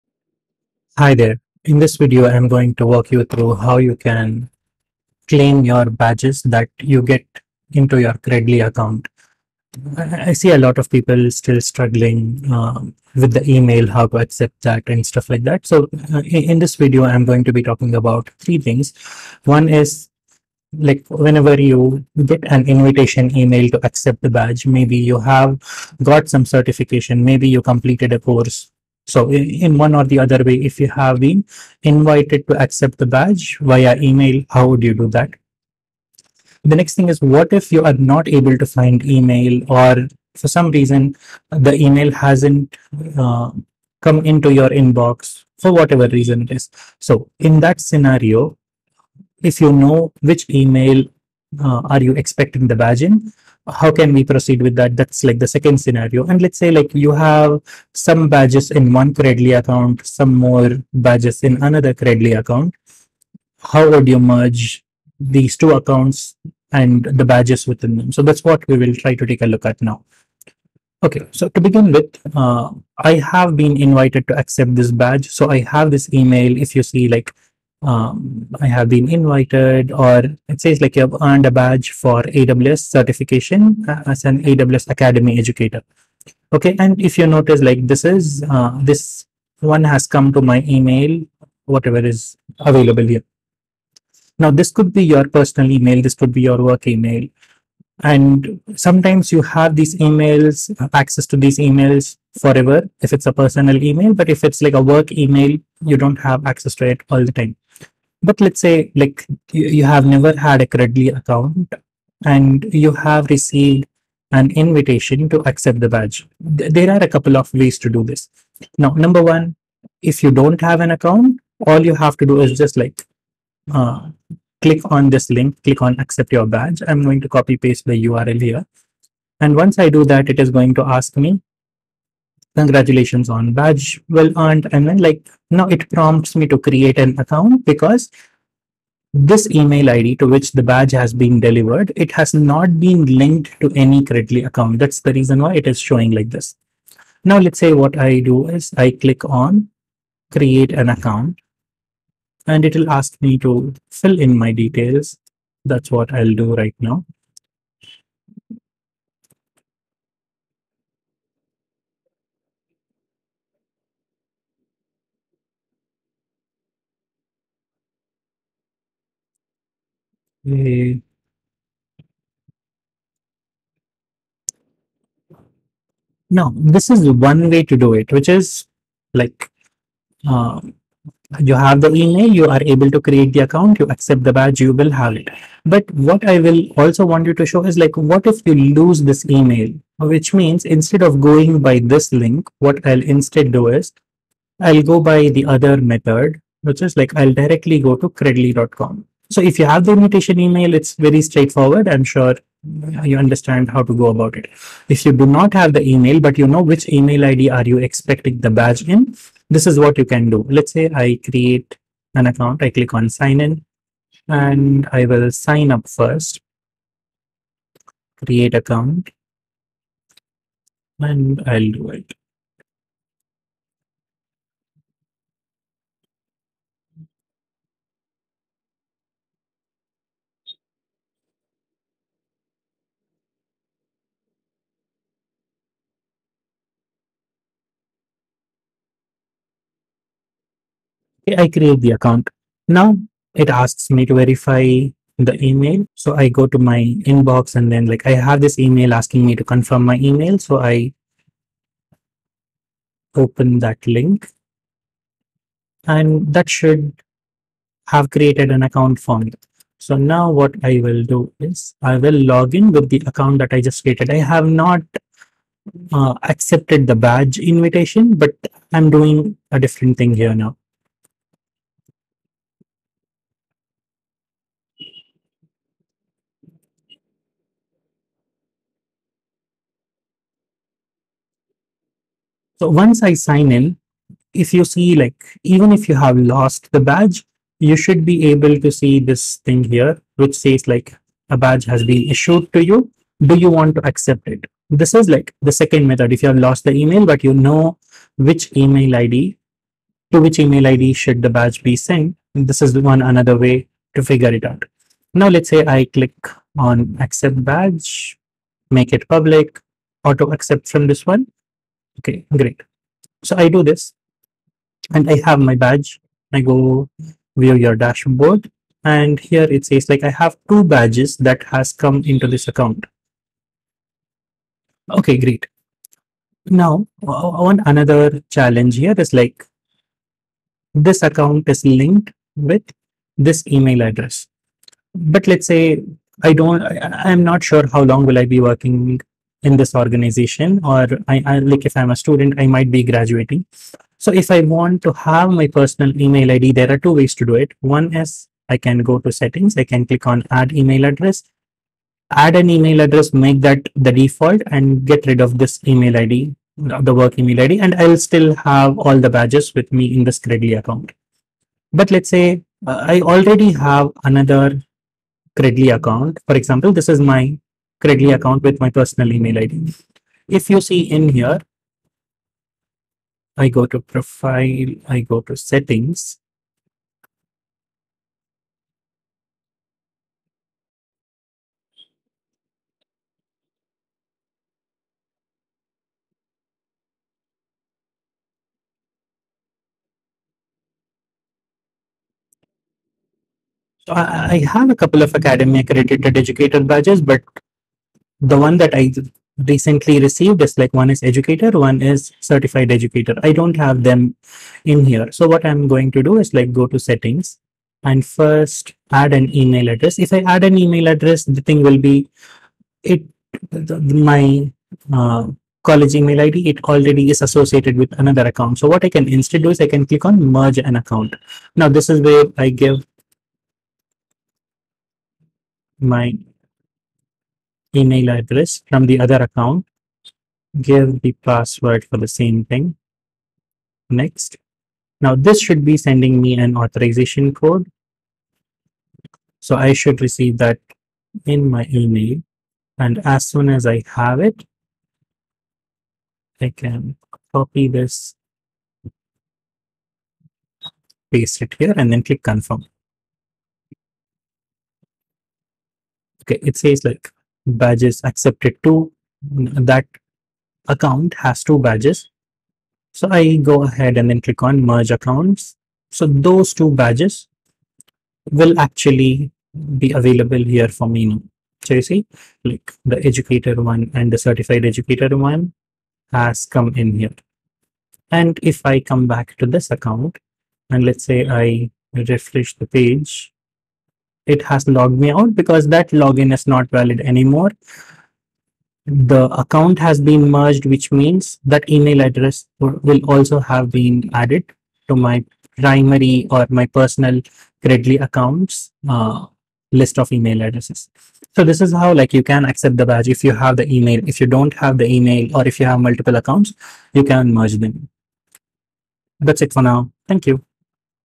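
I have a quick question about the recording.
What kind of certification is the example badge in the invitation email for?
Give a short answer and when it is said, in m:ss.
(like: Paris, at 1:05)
AWS certification, at 1:22.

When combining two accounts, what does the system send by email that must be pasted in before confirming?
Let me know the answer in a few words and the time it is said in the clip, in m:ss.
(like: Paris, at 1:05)
authorization code, at 7:16.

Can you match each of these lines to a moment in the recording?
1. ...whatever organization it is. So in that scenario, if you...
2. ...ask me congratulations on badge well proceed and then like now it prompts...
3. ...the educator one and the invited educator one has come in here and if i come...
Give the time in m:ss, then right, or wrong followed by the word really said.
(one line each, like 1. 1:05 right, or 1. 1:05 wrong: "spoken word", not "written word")
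1. 0:45 wrong: "reason", not "organization"
2. 2:10 wrong: "earned", not "proceed"
3. 7:52 wrong: "certified", not "invited".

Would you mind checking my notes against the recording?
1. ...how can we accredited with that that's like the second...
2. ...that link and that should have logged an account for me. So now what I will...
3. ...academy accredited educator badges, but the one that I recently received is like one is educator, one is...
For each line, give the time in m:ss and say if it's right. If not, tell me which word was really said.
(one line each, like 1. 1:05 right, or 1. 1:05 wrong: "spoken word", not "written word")
1. 0:53 wrong: "proceed", not "accredited"
2. 4:13 wrong: "created", not "logged"
3. 6:35 right.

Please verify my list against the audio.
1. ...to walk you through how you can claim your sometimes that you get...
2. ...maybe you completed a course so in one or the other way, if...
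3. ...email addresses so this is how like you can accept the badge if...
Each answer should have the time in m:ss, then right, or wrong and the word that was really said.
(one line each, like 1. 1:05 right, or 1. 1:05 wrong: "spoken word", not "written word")
1. 0:02 wrong: "badges", not "sometimes"
2. 0:27 right
3. 8:20 right.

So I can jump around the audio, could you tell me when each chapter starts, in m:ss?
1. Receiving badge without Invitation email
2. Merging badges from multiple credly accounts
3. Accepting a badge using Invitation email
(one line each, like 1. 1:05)
1. 3:05
2. 5:50
3. 1:13.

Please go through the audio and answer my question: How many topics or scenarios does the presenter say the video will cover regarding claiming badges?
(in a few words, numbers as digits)
3.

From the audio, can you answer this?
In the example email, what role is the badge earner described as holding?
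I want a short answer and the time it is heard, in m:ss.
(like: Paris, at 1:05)
AWS Academy educator, at 1:24.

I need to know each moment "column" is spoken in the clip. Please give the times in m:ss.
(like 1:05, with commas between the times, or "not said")
not said.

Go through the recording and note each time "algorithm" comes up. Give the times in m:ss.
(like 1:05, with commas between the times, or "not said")
not said.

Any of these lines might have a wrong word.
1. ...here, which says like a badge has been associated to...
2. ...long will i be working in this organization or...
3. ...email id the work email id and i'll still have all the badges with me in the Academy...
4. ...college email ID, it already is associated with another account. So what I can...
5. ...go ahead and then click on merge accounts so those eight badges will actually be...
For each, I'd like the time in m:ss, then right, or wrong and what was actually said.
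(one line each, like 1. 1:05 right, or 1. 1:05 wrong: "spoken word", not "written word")
1. 4:49 wrong: "issued", not "associated"
2. 5:37 right
3. 5:55 wrong: "Credly", not "Academy"
4. 6:55 right
5. 7:43 wrong: "two", not "eight".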